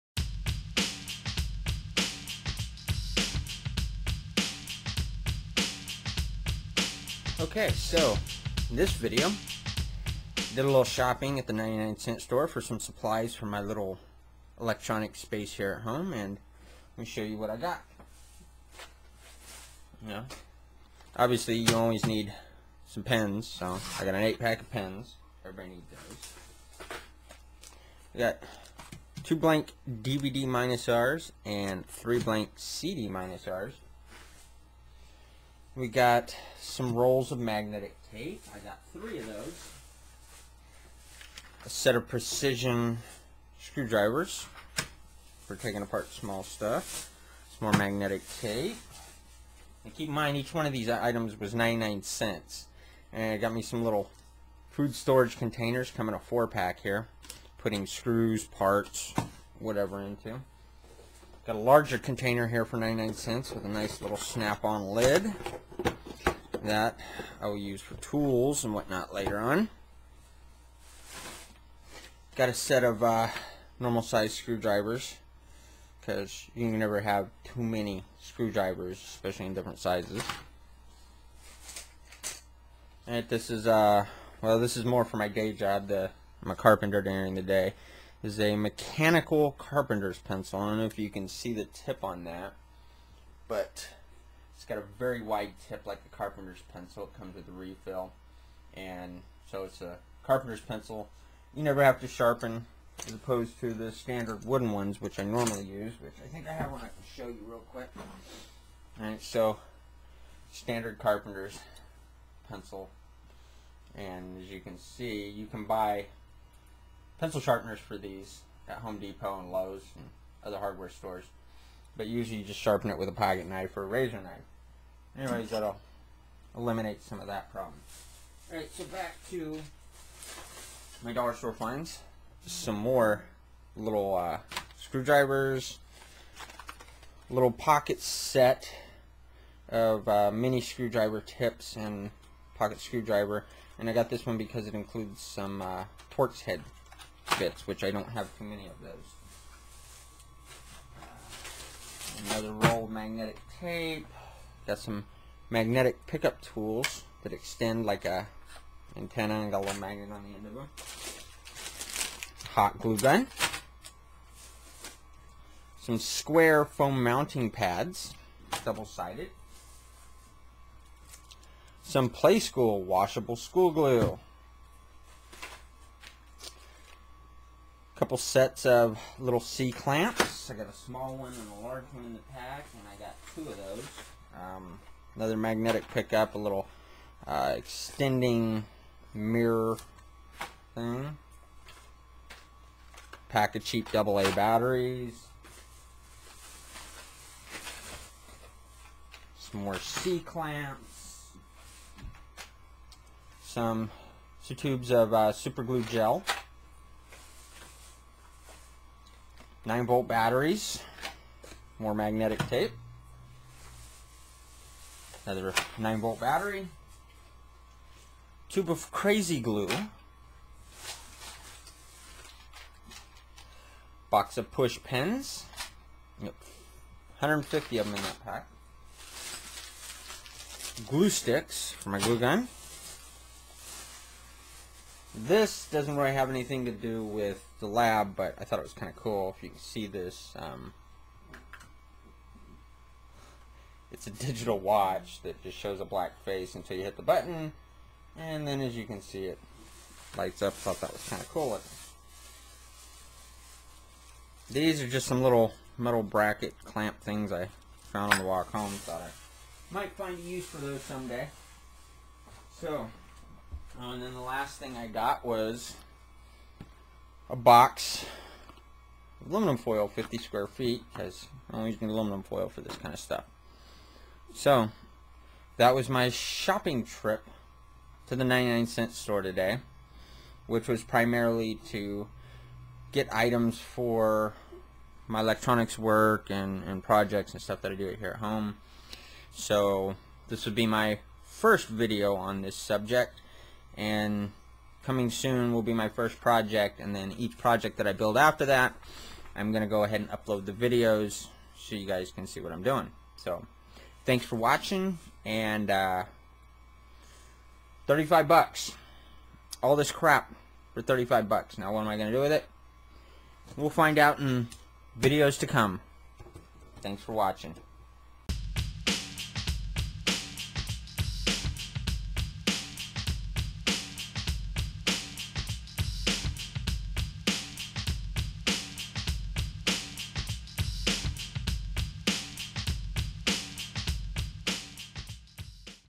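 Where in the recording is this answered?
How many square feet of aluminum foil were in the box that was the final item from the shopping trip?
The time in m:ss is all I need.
4:29.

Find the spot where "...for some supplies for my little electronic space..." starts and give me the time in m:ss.
0:12.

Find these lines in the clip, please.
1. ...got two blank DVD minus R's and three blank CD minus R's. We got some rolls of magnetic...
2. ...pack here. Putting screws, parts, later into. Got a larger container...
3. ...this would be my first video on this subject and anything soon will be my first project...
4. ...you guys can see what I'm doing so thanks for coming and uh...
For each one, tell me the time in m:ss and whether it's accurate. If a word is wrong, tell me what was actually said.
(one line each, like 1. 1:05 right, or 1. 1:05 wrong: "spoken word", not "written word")
1. 0:28 right
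2. 0:56 wrong: "whatever", not "later"
3. 4:50 wrong: "coming", not "anything"
4. 5:01 wrong: "watching", not "coming".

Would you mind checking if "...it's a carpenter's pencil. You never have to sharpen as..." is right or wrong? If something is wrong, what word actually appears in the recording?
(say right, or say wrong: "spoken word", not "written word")
right.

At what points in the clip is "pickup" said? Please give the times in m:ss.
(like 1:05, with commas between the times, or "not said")
2:36, 3:05.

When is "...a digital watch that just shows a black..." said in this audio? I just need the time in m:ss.
4:04.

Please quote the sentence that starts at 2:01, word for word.
But usually you just sharpen it with a pocket knife or a razor knife.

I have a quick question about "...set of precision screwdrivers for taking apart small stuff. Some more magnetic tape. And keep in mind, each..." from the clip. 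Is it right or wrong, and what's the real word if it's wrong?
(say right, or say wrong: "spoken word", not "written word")
right.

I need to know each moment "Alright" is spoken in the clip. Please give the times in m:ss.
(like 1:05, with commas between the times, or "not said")
1:49, 2:08.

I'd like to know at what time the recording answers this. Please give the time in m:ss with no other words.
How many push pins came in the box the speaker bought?
3:47.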